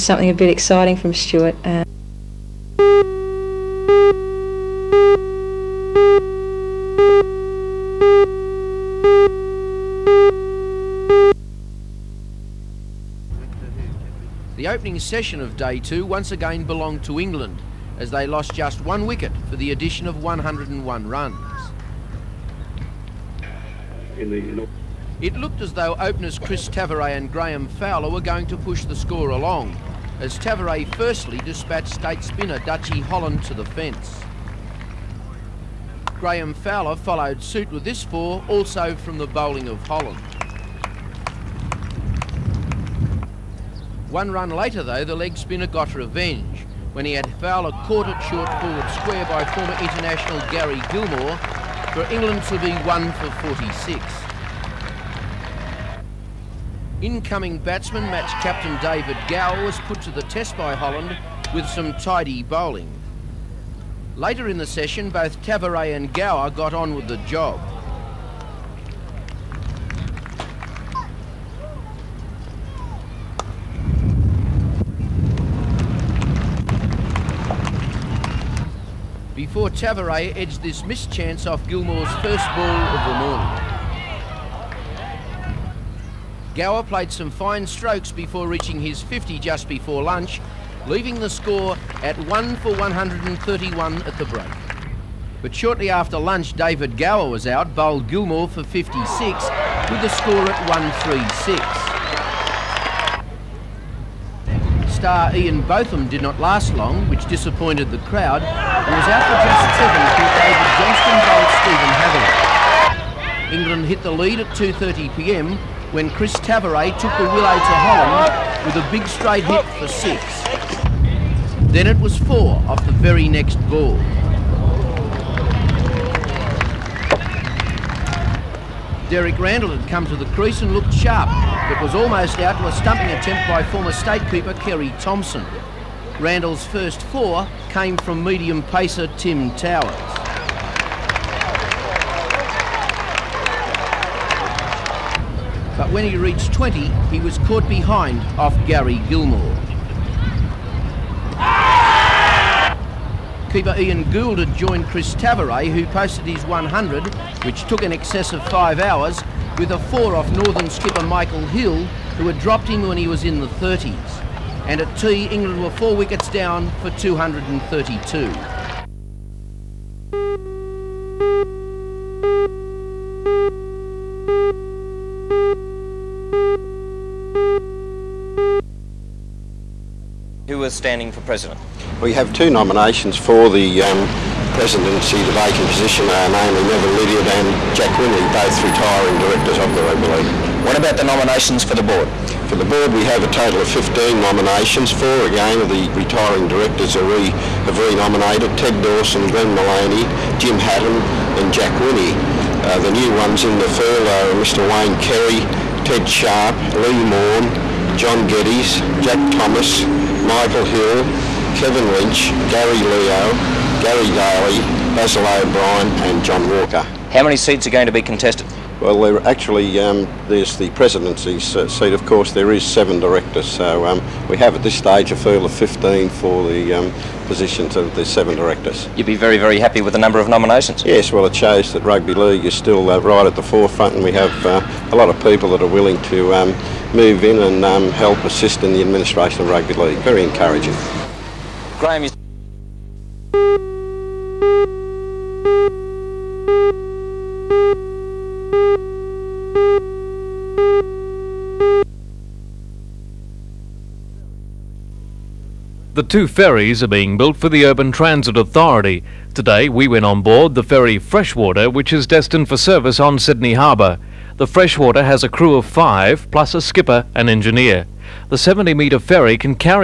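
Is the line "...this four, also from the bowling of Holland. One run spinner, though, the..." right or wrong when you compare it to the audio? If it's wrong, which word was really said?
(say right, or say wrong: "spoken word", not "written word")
wrong: "later", not "spinner".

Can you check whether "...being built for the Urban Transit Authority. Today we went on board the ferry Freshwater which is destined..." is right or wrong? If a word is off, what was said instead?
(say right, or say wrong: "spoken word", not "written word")
right.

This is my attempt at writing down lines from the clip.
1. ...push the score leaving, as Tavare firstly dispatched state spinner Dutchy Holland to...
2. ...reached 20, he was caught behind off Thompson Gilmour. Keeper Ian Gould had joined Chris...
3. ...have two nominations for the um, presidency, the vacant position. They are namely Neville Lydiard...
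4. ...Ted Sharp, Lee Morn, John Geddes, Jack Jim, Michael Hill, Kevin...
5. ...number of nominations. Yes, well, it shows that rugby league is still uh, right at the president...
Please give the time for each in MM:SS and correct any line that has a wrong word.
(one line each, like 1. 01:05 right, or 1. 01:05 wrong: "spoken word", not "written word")
1. 00:28 wrong: "along", not "leaving"
2. 02:26 wrong: "Gary", not "Thompson"
3. 03:02 right
4. 03:25 wrong: "Thomas", not "Jim"
5. 03:49 wrong: "forefront", not "president".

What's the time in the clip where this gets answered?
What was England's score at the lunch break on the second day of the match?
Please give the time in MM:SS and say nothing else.
01:32.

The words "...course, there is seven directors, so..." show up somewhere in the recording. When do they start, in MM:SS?
03:42.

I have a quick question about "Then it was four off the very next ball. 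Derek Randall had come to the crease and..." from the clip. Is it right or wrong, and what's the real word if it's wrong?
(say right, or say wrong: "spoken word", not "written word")
right.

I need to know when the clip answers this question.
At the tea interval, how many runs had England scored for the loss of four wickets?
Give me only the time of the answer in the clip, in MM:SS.
02:46.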